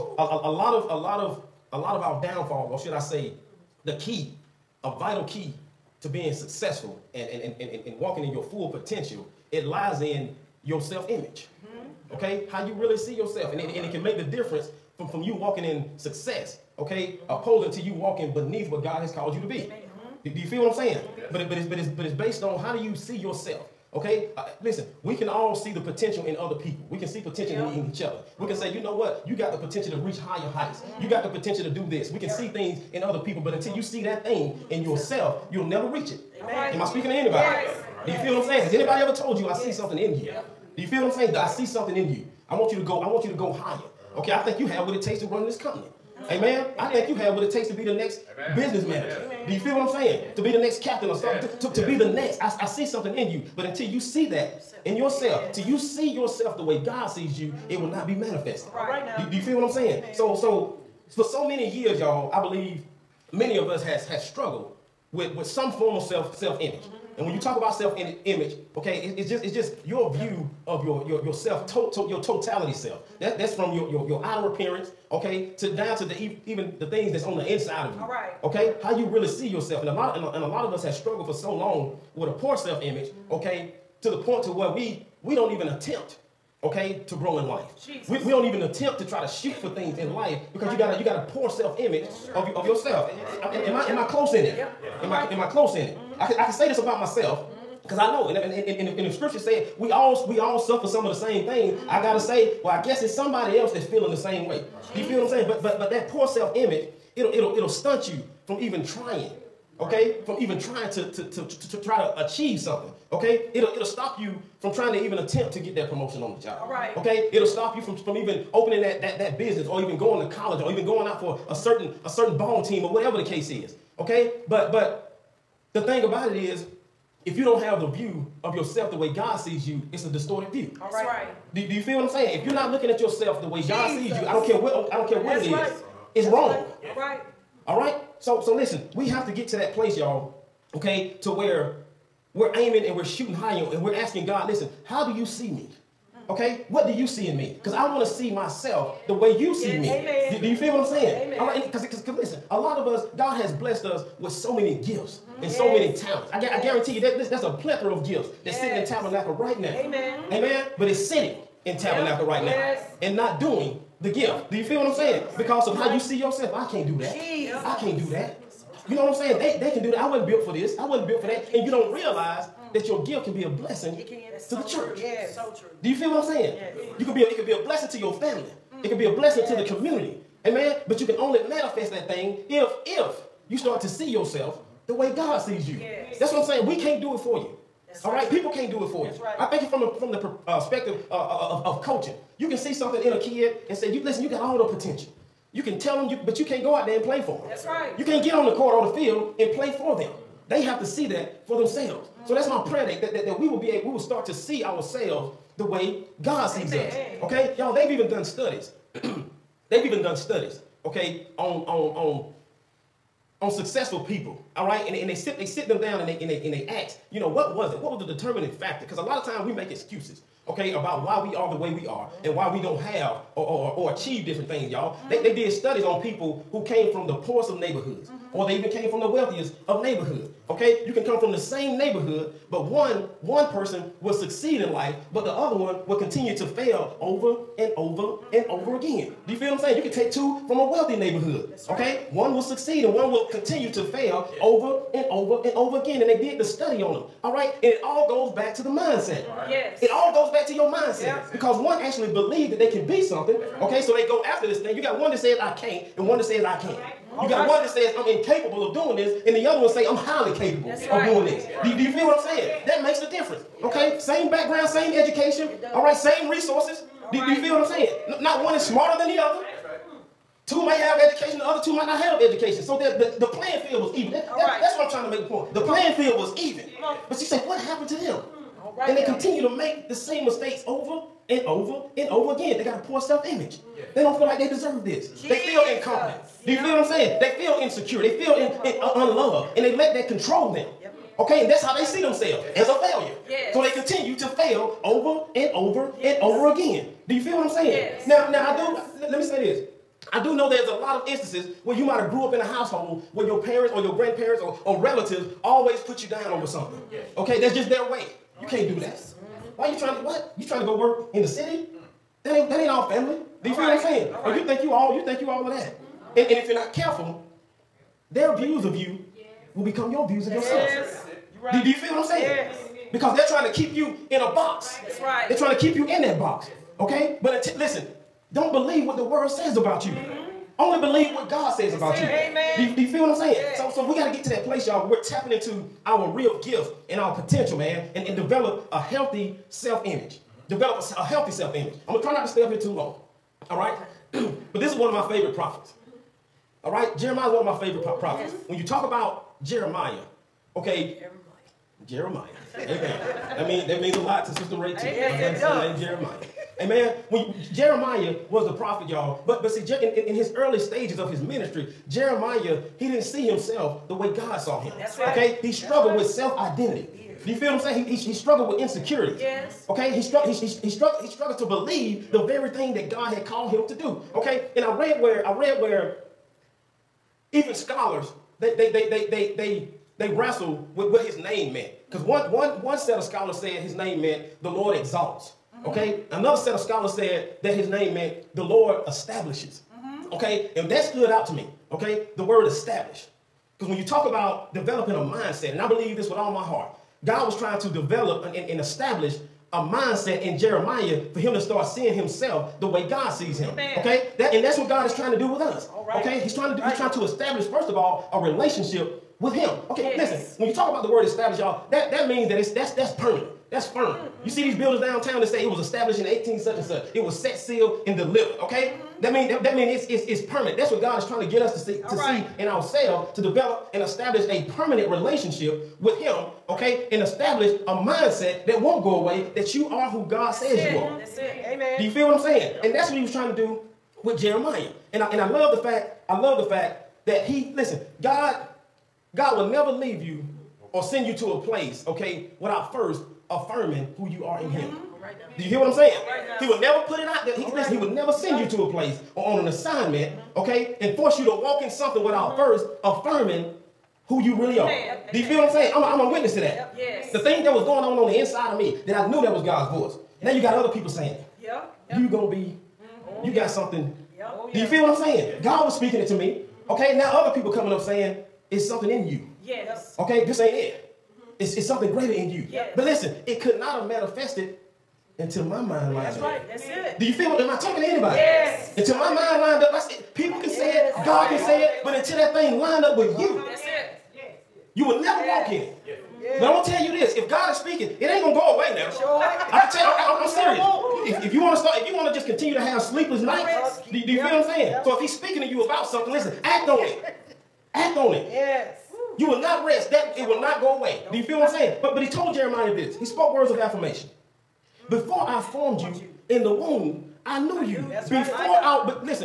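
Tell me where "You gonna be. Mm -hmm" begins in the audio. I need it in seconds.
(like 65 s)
461 s.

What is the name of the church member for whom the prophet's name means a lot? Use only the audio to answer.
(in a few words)
Sister Ray.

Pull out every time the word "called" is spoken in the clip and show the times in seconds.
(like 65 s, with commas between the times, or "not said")
19 s, 373 s.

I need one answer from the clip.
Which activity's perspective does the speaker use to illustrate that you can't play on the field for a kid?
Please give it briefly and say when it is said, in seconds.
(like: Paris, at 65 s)
coaching, at 191 s.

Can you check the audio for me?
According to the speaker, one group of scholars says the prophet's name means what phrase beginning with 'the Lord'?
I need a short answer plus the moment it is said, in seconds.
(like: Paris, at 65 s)
The Lord exalts, at 384 s.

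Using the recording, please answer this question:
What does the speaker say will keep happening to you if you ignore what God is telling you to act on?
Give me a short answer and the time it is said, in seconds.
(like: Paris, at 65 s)
sleepless nights, at 492 s.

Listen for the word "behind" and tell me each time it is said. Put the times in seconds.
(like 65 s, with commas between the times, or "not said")
not said.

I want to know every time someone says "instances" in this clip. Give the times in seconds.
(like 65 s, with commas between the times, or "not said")
301 s.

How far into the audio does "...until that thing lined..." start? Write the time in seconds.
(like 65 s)
481 s.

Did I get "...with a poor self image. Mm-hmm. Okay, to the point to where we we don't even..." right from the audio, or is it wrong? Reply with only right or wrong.
right.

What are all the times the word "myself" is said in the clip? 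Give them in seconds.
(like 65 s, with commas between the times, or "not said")
96 s, 148 s.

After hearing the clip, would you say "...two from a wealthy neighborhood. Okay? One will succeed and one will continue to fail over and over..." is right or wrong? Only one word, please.
right.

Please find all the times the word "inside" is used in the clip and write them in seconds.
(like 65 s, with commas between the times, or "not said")
77 s, 458 s.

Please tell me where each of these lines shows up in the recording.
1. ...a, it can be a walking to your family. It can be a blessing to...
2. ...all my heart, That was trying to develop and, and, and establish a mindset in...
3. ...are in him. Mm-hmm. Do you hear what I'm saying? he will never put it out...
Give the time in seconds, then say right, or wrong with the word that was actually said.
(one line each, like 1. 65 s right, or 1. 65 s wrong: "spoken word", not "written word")
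1. 177 s wrong: "blessing", not "walking"
2. 396 s wrong: "God", not "That"
3. 444 s right.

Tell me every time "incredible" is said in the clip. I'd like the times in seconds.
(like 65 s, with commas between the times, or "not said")
not said.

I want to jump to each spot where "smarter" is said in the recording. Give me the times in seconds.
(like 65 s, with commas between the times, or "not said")
268 s.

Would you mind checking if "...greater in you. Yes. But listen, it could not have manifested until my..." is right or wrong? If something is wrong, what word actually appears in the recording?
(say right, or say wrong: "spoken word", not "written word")
right.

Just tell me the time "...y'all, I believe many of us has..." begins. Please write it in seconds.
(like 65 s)
61 s.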